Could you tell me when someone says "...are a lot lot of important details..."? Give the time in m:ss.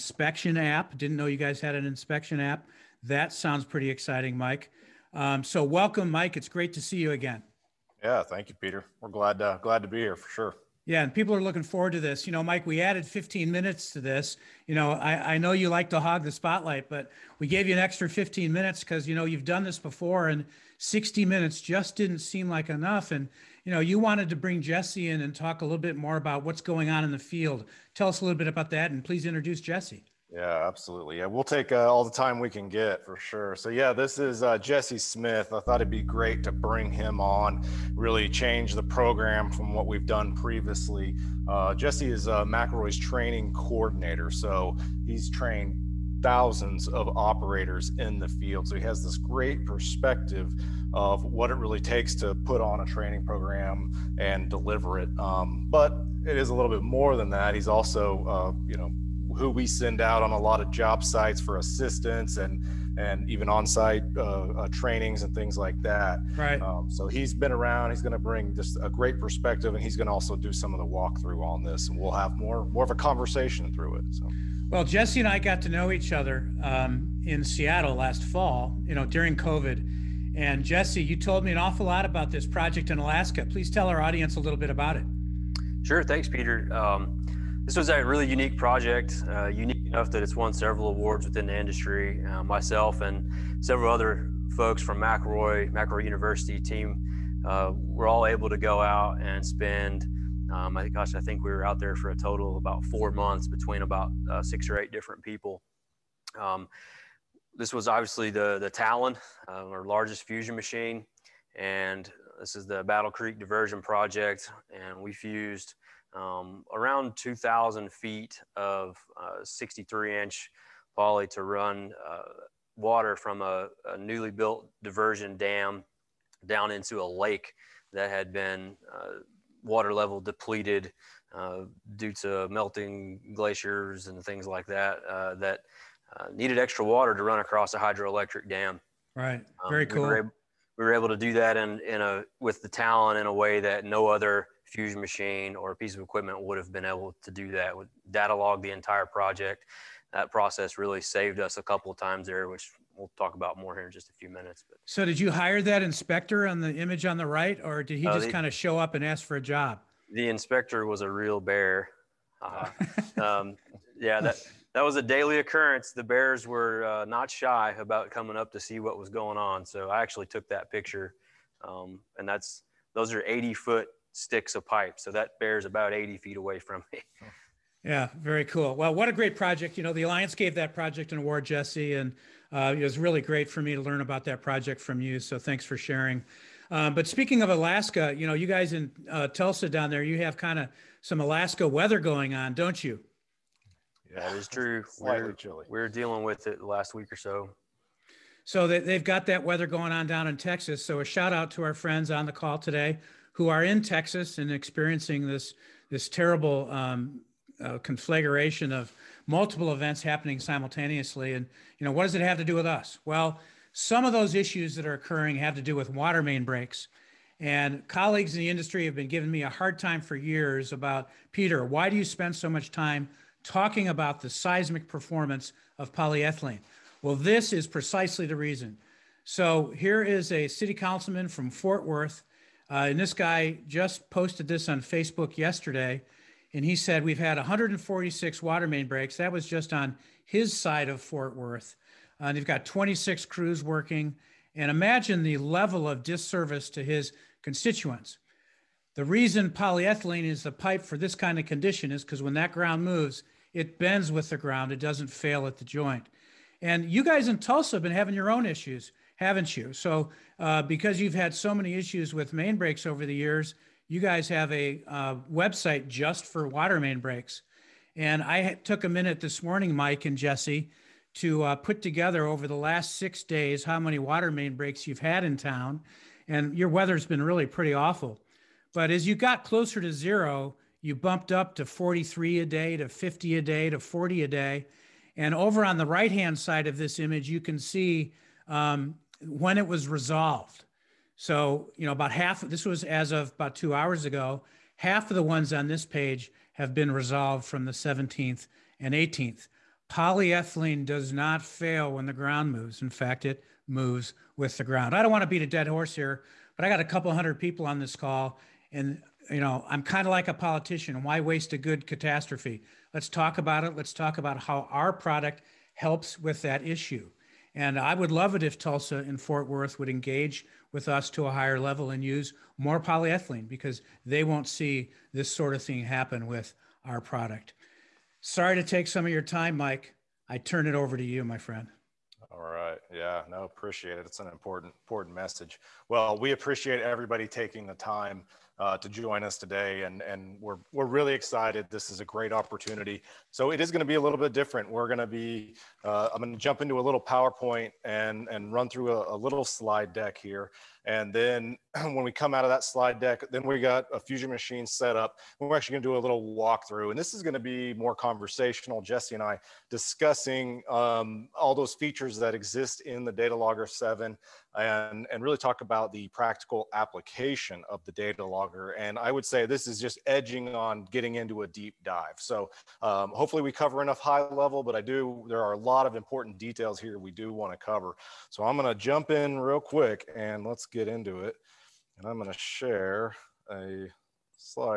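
6:15.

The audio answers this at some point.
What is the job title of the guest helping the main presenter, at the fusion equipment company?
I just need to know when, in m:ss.
0:42.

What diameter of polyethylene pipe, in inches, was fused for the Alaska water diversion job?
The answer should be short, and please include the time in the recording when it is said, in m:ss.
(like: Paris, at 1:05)
63-inch, at 1:59.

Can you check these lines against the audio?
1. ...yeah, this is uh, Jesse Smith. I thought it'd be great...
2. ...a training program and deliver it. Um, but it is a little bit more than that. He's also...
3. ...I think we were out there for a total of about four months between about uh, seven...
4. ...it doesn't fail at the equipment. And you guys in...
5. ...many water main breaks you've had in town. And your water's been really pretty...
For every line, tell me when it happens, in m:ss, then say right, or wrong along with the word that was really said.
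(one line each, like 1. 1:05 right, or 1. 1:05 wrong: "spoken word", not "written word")
1. 0:33 right
2. 0:52 right
3. 1:41 wrong: "six", not "seven"
4. 4:14 wrong: "joint", not "equipment"
5. 4:33 wrong: "weather", not "water".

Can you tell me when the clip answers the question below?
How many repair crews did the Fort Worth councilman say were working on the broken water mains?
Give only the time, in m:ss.
4:02.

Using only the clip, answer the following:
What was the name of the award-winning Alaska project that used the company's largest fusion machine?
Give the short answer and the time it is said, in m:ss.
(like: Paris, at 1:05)
Battle Creek Diversion Project, at 1:52.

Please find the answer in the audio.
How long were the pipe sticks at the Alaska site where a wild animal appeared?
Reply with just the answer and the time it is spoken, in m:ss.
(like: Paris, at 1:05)
80 feet, at 2:53.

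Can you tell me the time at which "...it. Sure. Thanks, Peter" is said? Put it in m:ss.
1:24.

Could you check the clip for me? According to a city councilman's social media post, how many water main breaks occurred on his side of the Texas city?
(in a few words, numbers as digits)
146.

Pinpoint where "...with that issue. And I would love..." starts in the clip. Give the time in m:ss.
5:16.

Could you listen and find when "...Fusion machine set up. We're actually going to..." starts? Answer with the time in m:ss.
5:54.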